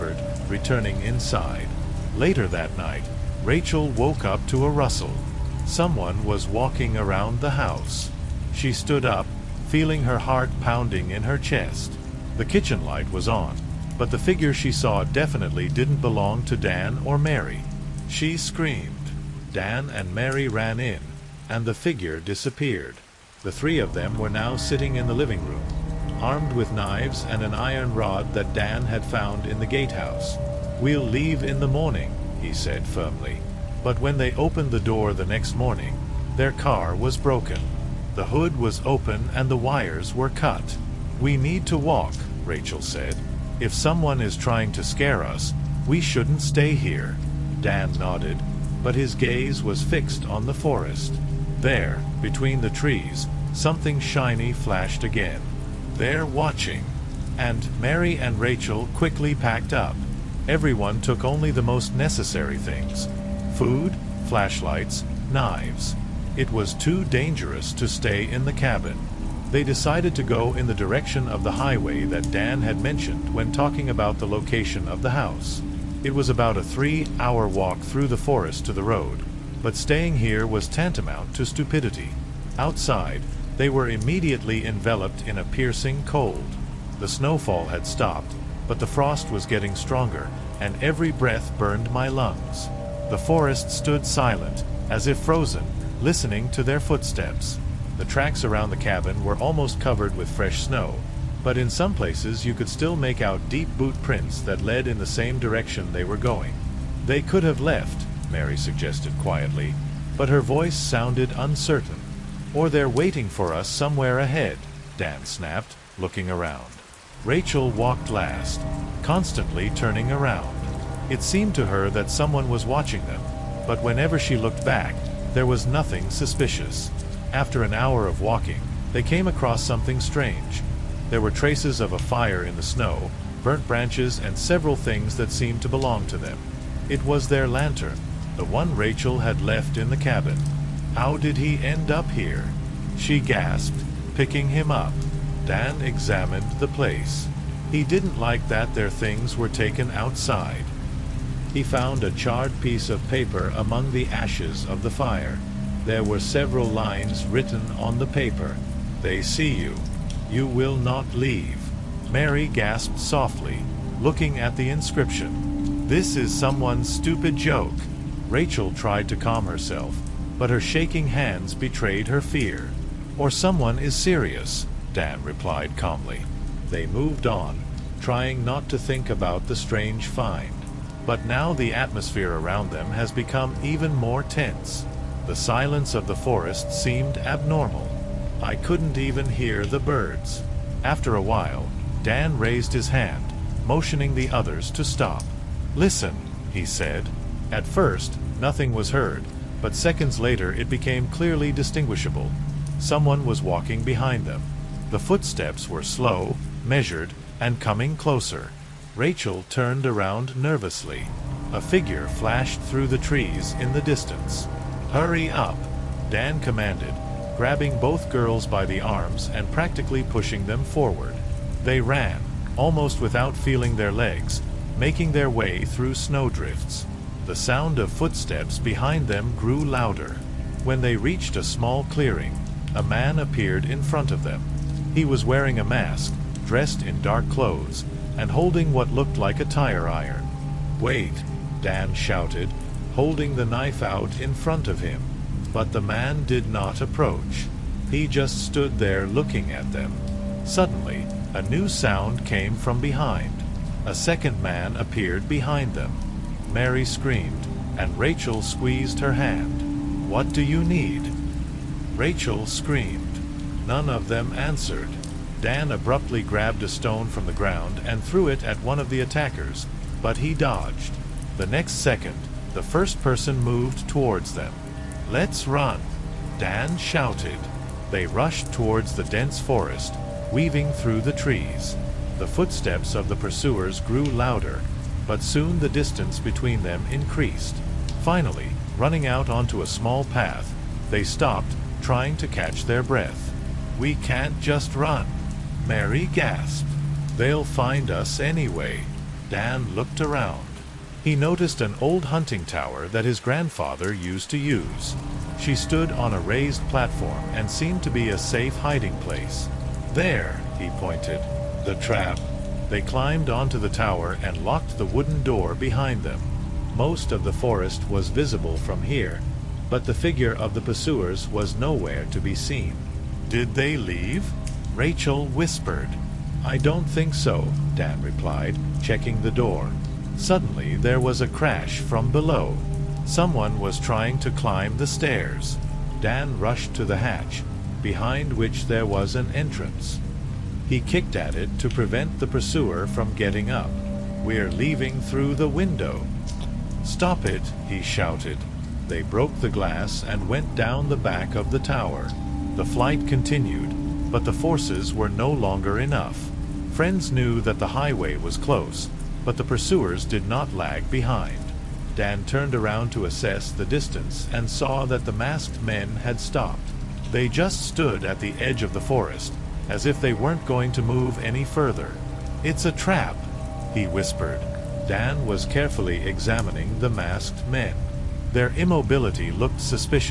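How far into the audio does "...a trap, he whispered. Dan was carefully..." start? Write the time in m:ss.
6:12.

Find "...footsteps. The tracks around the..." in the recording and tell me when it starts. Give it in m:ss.
1:36.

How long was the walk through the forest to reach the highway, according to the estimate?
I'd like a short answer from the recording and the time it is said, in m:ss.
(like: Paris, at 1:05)
3 hours, at 1:16.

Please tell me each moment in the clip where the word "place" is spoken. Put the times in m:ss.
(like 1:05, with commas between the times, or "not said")
1:41, 2:26, 5:08.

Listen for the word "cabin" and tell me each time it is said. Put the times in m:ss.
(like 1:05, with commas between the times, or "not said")
1:08, 1:38, 2:19.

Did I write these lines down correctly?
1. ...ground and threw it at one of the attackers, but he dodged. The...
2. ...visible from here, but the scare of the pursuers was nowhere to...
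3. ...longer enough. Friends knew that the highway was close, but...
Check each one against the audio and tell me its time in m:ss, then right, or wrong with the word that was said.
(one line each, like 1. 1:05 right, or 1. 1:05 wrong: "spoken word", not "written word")
1. 4:27 right
2. 5:18 wrong: "figure", not "scare"
3. 5:55 right.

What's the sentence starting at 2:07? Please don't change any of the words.
After an hour of walking, they came across something strange.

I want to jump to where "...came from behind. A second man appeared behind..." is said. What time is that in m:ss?
4:12.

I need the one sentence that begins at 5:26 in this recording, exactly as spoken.
I don't think so, Dan replied, checking the door.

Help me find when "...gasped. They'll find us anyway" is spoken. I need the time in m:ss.
4:56.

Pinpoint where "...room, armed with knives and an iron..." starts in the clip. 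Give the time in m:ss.
0:25.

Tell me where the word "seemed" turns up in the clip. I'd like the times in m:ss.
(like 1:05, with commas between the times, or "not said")
2:01, 2:15, 3:06, 5:07.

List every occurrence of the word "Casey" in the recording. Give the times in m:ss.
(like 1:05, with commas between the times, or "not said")
not said.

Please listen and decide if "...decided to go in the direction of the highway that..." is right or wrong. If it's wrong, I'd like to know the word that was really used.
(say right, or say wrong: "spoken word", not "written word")
right.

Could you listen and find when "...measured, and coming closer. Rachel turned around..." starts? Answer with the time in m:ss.
3:26.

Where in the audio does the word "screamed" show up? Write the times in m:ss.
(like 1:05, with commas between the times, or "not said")
0:18, 4:16, 4:22.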